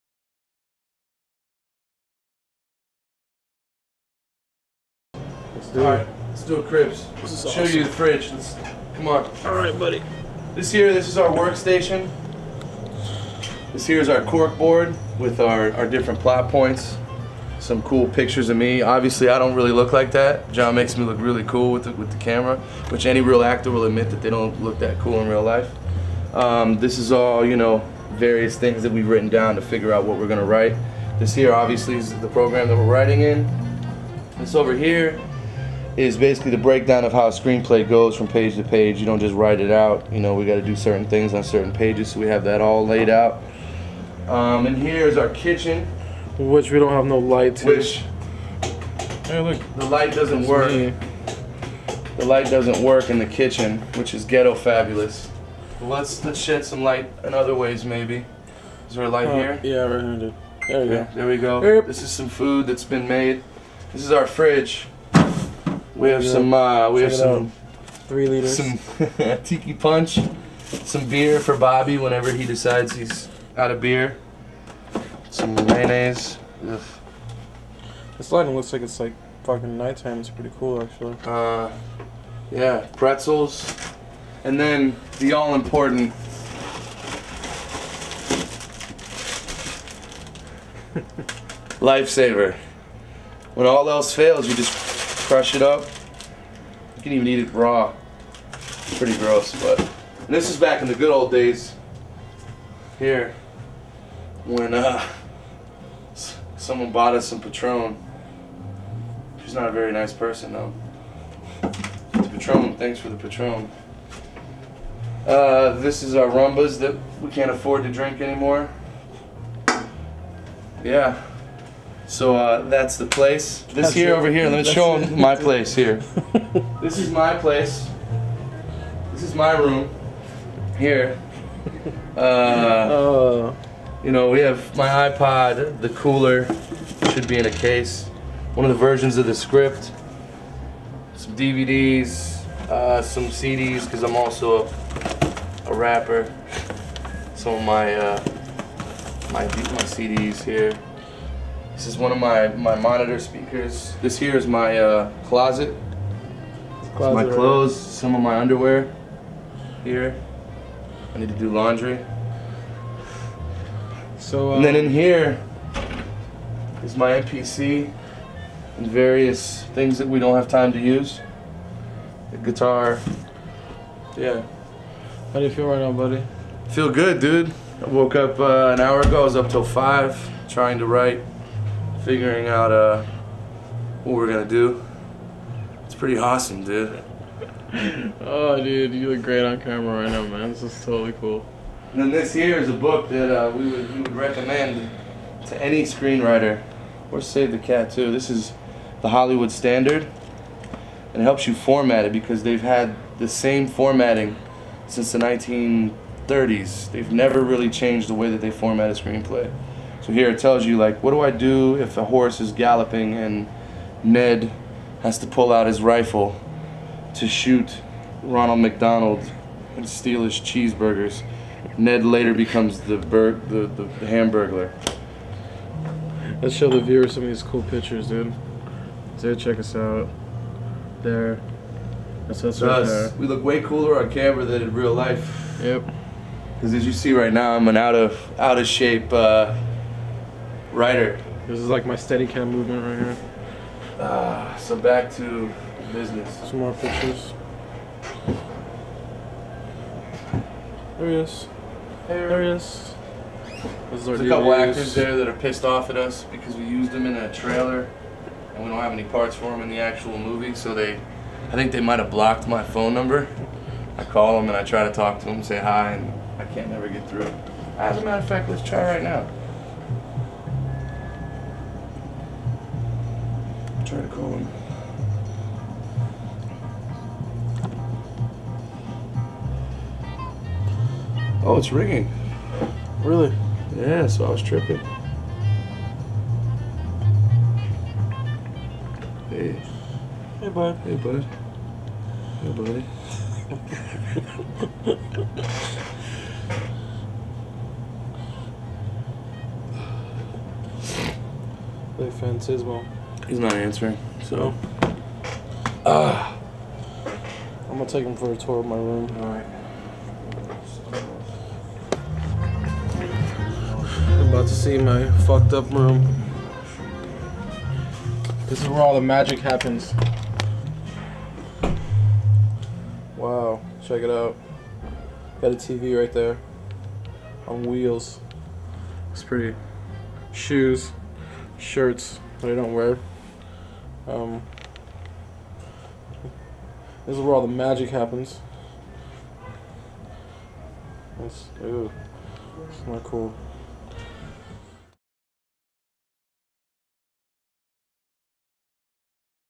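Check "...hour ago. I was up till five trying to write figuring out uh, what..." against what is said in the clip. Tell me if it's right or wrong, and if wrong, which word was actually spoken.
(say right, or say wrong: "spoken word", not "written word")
right.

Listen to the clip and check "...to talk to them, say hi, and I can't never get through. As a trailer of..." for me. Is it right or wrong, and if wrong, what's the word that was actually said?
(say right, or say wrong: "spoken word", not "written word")
wrong: "matter", not "trailer".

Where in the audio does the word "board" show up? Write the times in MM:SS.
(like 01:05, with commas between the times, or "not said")
00:14.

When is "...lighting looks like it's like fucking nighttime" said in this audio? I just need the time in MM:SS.
01:18.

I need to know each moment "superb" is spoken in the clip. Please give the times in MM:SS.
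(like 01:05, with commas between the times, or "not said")
not said.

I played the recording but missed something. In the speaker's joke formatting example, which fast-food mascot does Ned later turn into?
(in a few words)
The Hamburglar.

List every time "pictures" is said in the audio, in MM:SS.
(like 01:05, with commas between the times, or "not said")
00:18, 03:47, 04:06.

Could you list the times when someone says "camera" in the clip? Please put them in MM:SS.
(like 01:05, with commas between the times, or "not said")
00:22, 03:09, 03:54.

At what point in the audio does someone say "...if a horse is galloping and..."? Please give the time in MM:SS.
03:31.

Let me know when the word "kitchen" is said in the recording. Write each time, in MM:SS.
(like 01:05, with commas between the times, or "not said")
00:45, 00:53.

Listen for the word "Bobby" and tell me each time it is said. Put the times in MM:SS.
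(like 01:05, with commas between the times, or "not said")
01:11.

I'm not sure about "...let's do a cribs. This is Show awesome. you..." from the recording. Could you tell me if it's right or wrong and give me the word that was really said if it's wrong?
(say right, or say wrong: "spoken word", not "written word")
right.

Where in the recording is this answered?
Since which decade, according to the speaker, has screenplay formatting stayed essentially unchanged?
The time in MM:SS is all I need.
03:25.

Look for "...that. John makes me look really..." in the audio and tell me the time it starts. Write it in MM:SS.
00:20.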